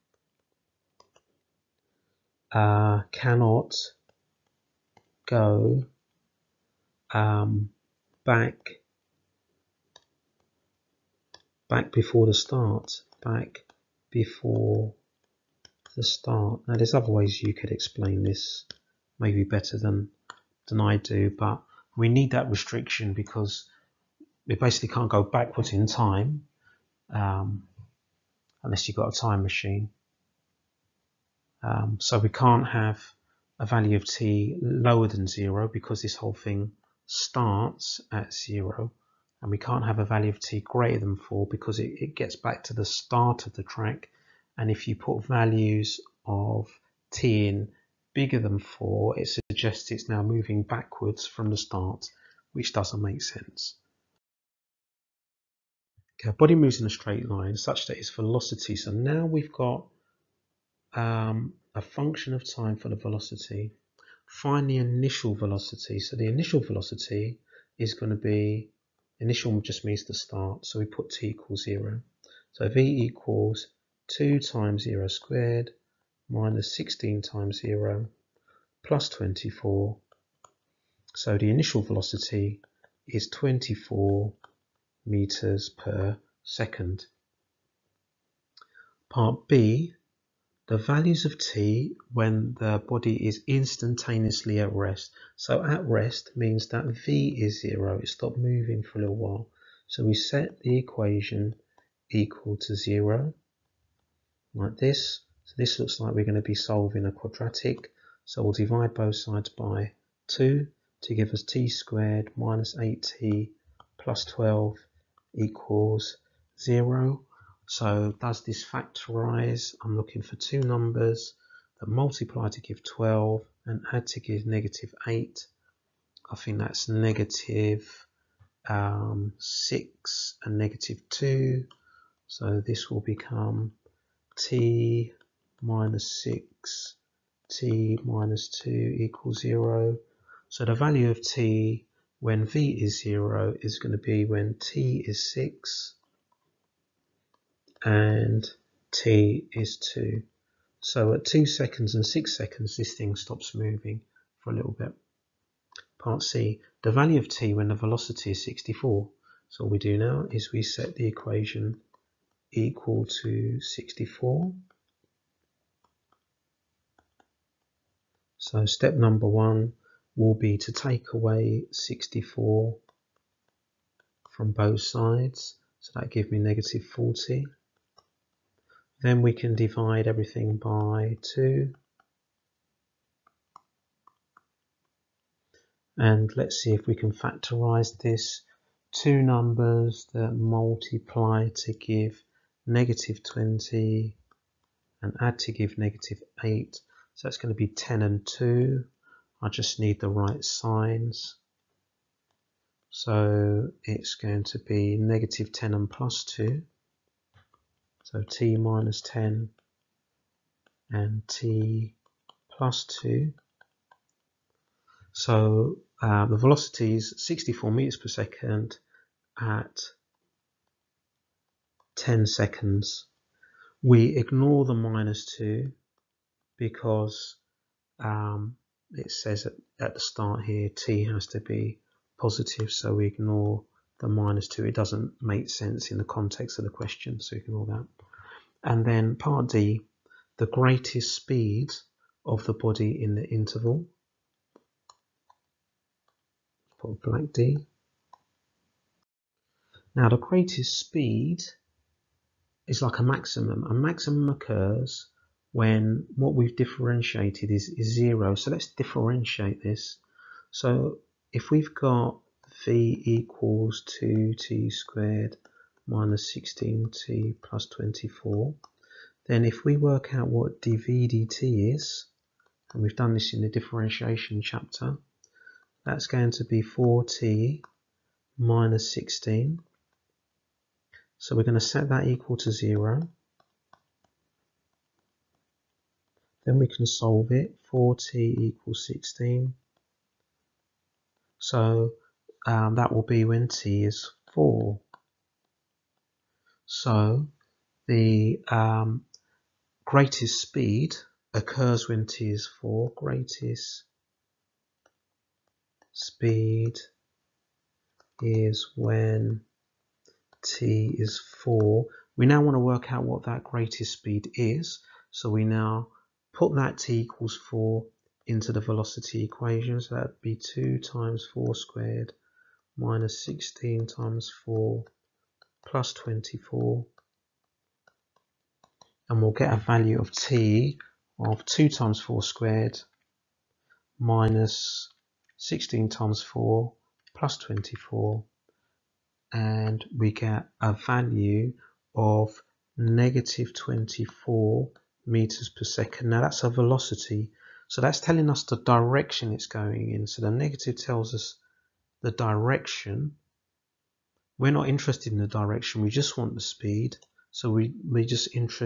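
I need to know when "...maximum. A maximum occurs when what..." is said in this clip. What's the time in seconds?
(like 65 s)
253 s.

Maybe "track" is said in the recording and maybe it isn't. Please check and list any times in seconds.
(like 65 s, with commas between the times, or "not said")
43 s.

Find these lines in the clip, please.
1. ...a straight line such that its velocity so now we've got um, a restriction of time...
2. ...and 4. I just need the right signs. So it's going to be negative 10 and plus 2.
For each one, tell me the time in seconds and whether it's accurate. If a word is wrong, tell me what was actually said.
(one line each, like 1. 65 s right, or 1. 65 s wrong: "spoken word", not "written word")
1. 56 s wrong: "function", not "restriction"
2. 197 s wrong: "2", not "4".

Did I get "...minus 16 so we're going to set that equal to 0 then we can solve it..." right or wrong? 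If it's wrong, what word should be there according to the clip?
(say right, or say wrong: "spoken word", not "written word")
right.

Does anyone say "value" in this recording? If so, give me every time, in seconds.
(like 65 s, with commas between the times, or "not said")
33 s, 40 s, 45 s, 90 s, 140 s, 156 s, 329 s, 340 s.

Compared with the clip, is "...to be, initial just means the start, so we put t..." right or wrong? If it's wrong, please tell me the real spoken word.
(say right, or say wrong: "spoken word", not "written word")
right.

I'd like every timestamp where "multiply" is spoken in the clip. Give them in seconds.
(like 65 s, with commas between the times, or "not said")
121 s, 190 s.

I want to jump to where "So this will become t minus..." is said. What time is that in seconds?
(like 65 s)
132 s.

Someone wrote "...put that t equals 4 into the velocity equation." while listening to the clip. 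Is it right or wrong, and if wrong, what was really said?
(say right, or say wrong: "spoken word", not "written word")
right.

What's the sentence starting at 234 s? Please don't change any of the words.
It doesn't make sense in the context of the question, so ignore that.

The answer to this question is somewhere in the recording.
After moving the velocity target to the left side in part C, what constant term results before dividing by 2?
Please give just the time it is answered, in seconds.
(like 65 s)
176 s.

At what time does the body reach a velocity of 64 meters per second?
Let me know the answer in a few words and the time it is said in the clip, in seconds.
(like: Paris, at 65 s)
10 seconds, at 221 s.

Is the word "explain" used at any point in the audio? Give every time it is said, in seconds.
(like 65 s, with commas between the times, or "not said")
17 s.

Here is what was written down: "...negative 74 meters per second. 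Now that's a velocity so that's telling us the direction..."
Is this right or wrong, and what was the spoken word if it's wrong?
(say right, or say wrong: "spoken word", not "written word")
wrong: "24", not "74".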